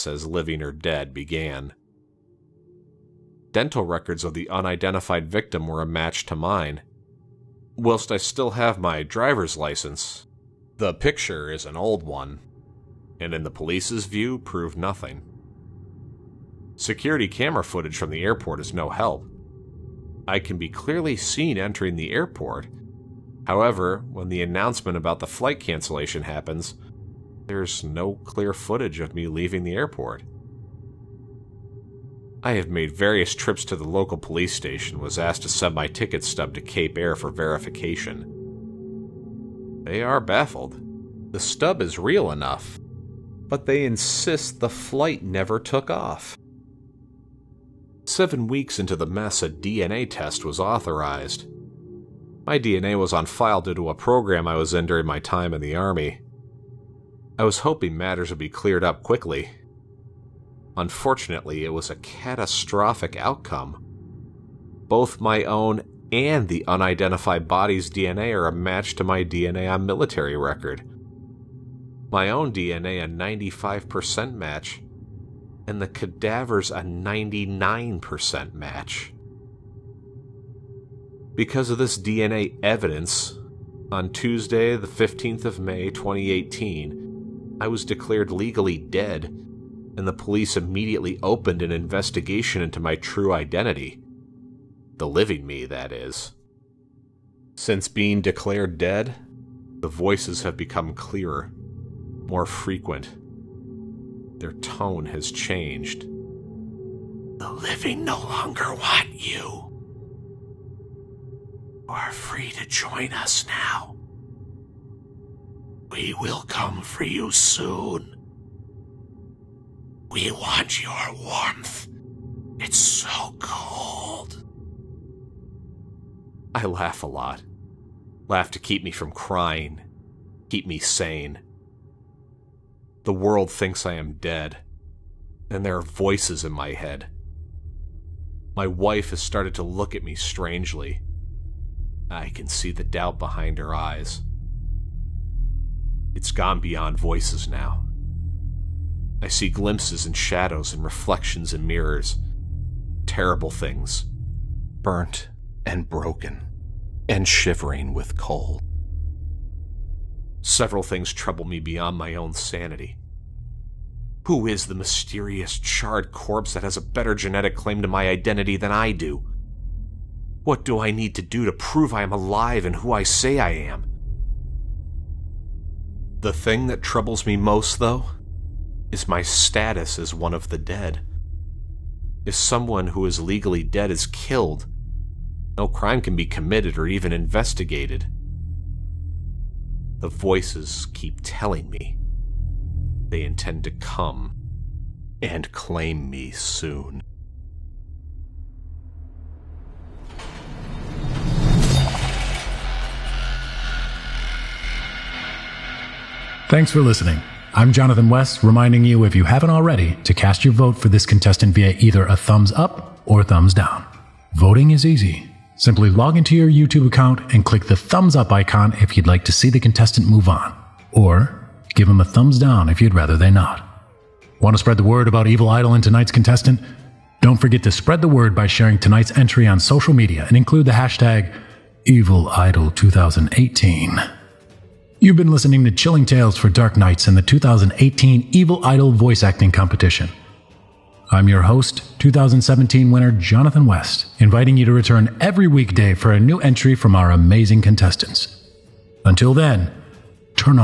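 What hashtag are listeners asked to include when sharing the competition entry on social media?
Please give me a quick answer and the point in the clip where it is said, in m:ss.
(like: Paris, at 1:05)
#EvilIdol2018, at 3:51.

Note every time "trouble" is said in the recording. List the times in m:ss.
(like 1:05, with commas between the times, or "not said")
2:41, 2:56.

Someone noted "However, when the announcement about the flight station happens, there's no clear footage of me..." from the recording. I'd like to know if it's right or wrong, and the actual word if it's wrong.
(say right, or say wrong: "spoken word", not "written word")
wrong: "cancellation", not "station".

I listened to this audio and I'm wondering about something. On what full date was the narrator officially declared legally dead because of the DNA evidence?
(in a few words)
Tuesday, 15 May 2018.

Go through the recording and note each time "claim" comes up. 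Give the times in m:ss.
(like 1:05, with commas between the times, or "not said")
2:47, 3:15.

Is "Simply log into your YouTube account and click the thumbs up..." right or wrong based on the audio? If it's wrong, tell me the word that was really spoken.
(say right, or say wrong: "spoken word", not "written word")
right.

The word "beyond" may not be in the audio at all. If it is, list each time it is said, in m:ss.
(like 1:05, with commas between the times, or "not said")
2:26, 2:41.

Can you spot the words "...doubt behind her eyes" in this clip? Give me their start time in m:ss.
2:22.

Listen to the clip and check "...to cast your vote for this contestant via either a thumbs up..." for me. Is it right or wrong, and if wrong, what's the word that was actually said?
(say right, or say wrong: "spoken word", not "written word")
right.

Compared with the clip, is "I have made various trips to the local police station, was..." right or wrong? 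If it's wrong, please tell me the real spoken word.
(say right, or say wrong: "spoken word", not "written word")
right.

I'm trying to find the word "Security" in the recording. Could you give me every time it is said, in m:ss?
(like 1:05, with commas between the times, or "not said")
0:16.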